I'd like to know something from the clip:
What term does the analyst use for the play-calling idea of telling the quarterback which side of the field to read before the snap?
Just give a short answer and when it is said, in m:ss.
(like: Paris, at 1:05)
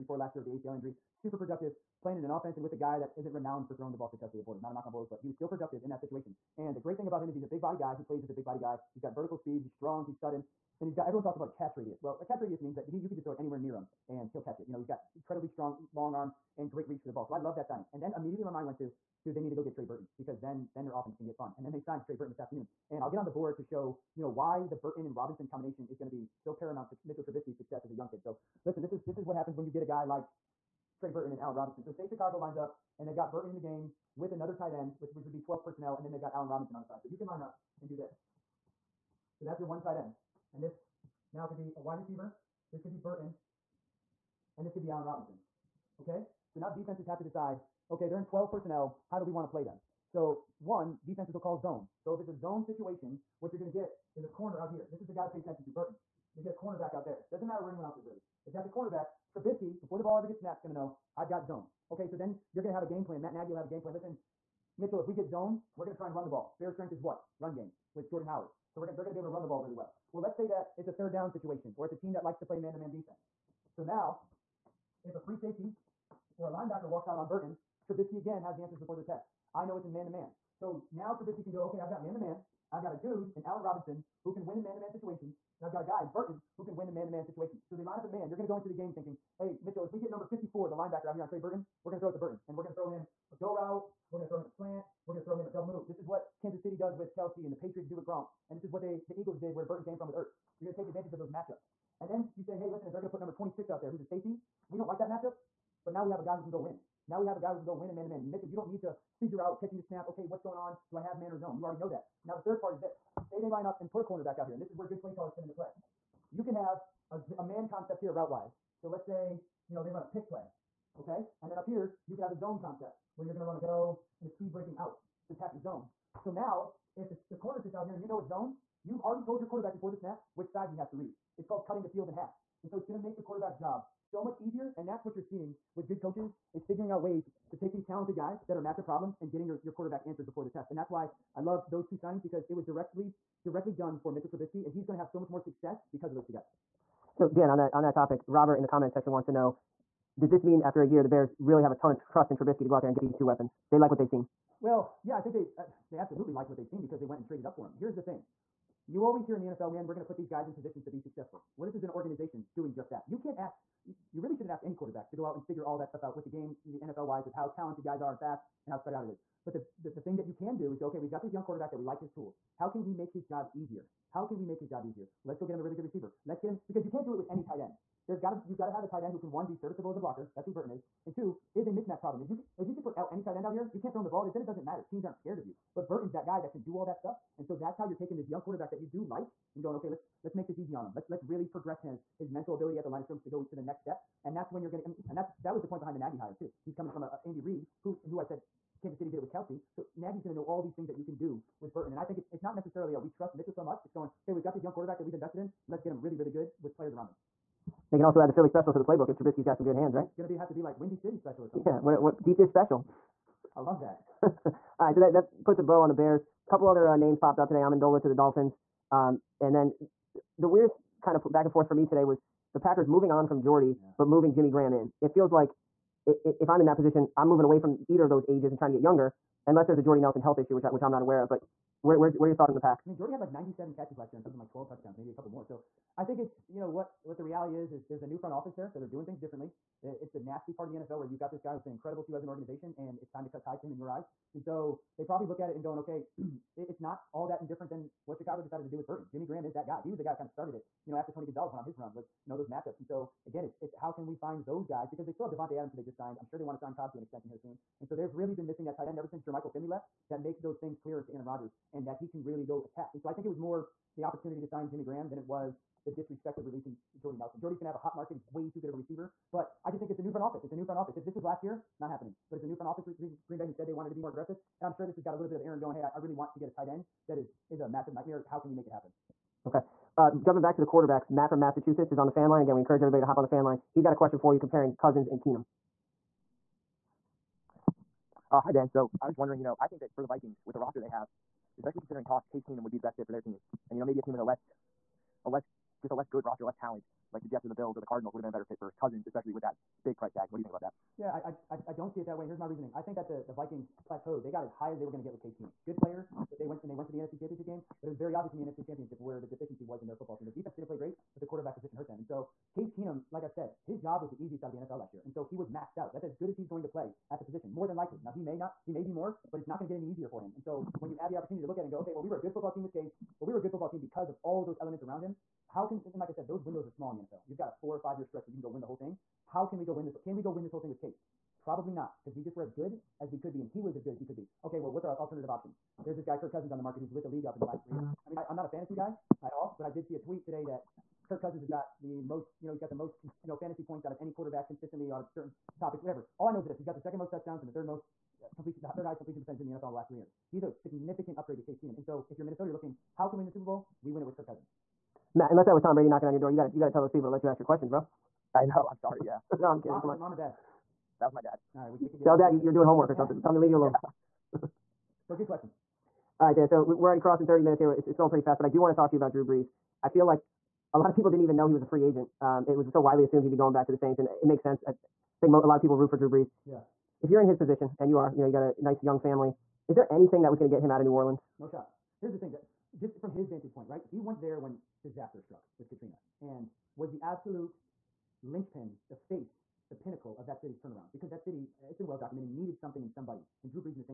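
cutting the field in half, at 2:11.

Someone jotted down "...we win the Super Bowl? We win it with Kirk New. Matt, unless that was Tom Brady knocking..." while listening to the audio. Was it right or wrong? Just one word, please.
wrong.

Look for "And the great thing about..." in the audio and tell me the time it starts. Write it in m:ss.
0:06.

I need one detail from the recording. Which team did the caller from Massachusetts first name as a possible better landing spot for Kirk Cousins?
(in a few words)
Jets.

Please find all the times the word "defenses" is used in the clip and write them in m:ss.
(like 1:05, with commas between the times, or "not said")
0:46, 0:51, 1:12, 5:10.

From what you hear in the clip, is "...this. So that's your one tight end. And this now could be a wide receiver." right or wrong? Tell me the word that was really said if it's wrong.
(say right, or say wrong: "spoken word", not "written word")
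right.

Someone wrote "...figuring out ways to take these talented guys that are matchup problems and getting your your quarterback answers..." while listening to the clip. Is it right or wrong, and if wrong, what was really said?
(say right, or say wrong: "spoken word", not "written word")
right.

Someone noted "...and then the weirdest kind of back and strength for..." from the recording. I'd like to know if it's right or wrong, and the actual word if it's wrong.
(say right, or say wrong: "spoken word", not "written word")
wrong: "forth", not "strength".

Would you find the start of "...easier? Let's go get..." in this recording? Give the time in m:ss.
2:54.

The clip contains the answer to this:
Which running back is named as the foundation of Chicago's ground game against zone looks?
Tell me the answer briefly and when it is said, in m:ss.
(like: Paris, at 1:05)
Jordan Howard, at 1:08.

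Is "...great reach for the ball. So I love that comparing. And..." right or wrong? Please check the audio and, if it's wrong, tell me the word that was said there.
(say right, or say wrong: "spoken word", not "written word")
wrong: "signing", not "comparing".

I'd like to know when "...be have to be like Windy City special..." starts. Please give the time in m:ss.
3:30.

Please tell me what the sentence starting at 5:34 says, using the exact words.
Okay, well, what's our alternative options?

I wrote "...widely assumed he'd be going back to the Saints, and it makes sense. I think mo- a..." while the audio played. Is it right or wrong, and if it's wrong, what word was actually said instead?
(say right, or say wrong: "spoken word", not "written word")
right.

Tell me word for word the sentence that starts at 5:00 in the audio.
What do you think about that?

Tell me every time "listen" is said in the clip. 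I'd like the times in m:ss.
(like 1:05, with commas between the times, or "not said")
0:28, 1:03, 1:42.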